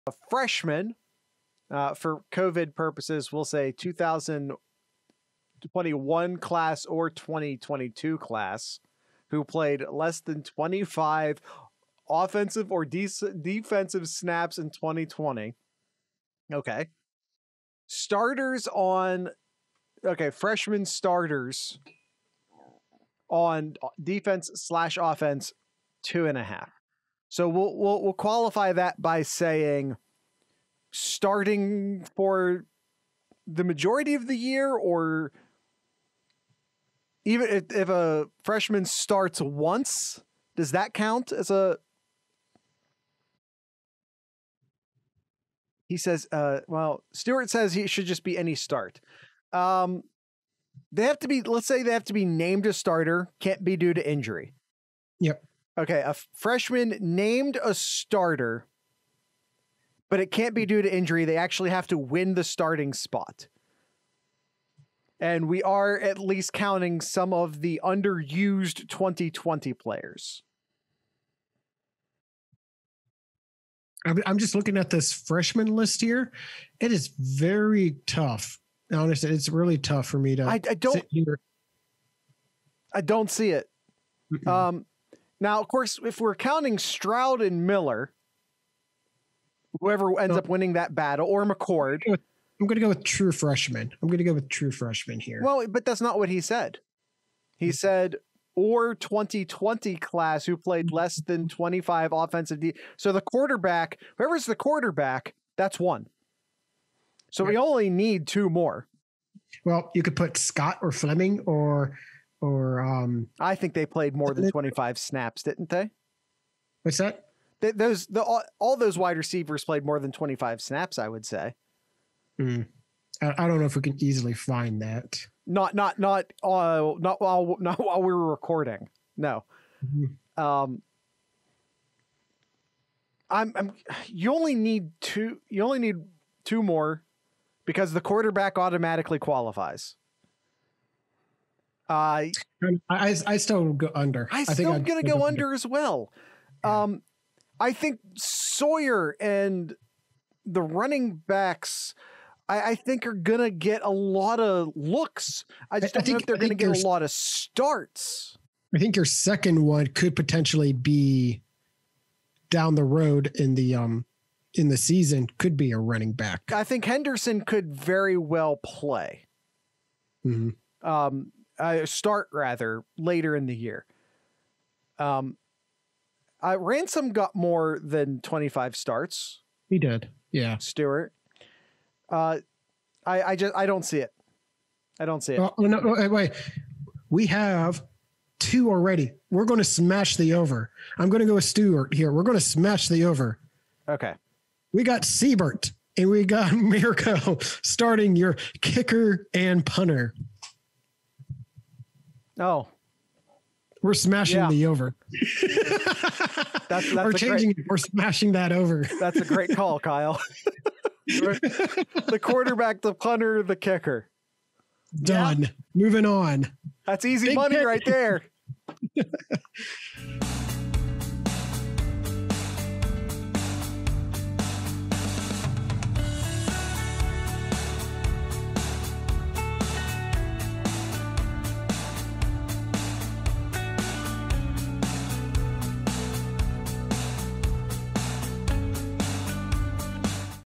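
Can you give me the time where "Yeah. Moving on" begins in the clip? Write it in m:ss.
3:35.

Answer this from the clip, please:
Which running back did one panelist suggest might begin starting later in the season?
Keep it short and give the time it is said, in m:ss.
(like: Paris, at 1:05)
Henderson, at 2:46.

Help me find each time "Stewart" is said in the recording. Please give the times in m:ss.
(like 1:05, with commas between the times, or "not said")
0:47, 3:00, 3:11.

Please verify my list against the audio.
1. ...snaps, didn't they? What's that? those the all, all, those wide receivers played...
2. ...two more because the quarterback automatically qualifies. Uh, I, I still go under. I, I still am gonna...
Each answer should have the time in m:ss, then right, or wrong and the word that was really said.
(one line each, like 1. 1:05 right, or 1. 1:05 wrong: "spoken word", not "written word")
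1. 1:54 right
2. 2:16 right.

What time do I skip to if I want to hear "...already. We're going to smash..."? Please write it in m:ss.
3:08.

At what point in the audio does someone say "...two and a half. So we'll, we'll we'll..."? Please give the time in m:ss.
0:26.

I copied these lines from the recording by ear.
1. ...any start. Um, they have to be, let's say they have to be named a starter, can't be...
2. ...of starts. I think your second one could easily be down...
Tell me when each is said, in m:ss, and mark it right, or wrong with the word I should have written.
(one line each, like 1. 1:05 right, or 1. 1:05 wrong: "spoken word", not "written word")
1. 0:48 right
2. 2:37 wrong: "potentially", not "easily".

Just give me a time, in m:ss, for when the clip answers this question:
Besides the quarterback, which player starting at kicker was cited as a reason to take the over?
3:15.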